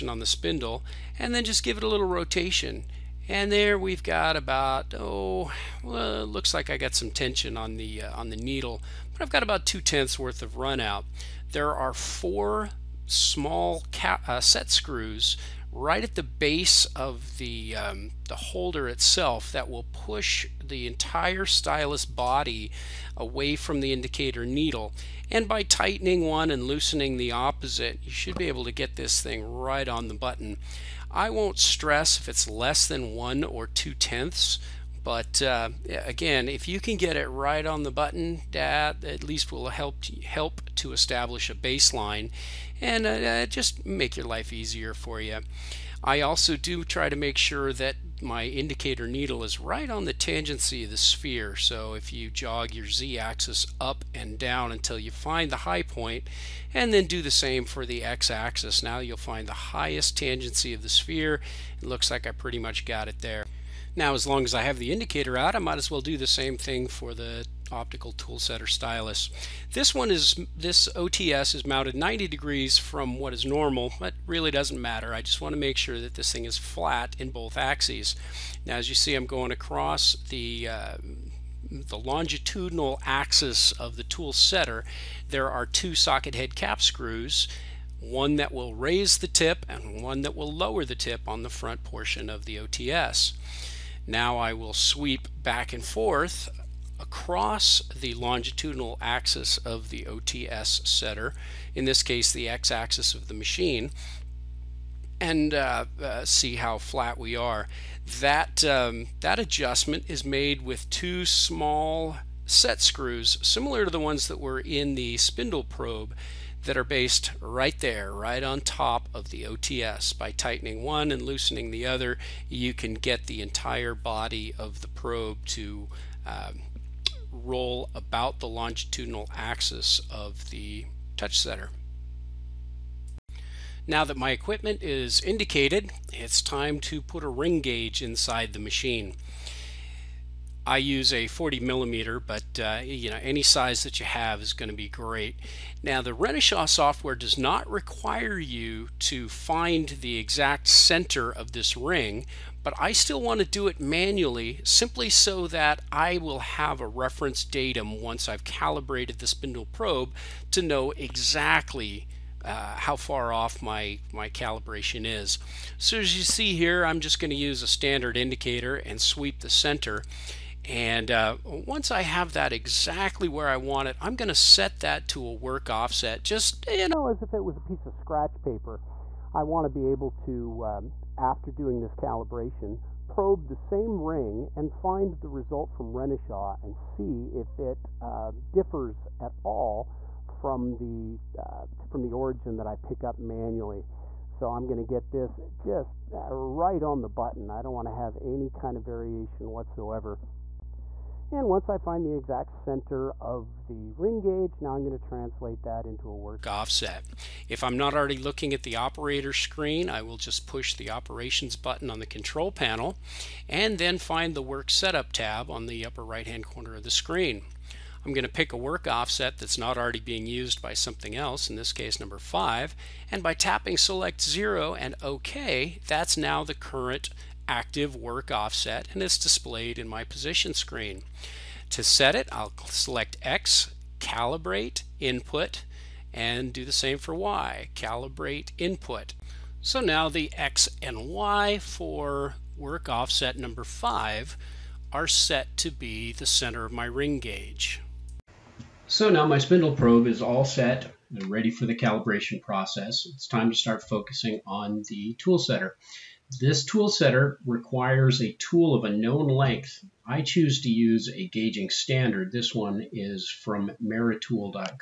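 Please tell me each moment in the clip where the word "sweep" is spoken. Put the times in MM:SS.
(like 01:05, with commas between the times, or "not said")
01:34, 02:49.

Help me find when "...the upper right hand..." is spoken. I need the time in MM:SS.
03:35.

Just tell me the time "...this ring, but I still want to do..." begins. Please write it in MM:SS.
02:31.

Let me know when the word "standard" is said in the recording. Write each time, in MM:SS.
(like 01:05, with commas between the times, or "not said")
02:47, 04:21.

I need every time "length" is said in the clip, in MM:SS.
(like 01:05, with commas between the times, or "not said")
04:19.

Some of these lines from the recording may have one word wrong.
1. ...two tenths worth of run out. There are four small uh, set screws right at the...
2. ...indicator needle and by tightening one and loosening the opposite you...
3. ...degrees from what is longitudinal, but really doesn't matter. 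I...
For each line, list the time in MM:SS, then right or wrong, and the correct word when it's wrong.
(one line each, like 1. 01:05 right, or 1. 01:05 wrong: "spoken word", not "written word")
1. 00:09 right
2. 00:23 right
3. 01:12 wrong: "normal", not "longitudinal".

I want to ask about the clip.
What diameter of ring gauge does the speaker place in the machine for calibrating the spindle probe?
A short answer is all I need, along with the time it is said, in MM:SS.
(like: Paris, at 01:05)
40 millimeter, at 02:21.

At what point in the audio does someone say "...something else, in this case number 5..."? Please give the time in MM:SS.
03:40.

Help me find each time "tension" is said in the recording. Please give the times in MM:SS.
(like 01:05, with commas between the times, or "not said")
00:07.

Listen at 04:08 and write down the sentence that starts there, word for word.
So now my spindle probe is all set and ready for the calibration process.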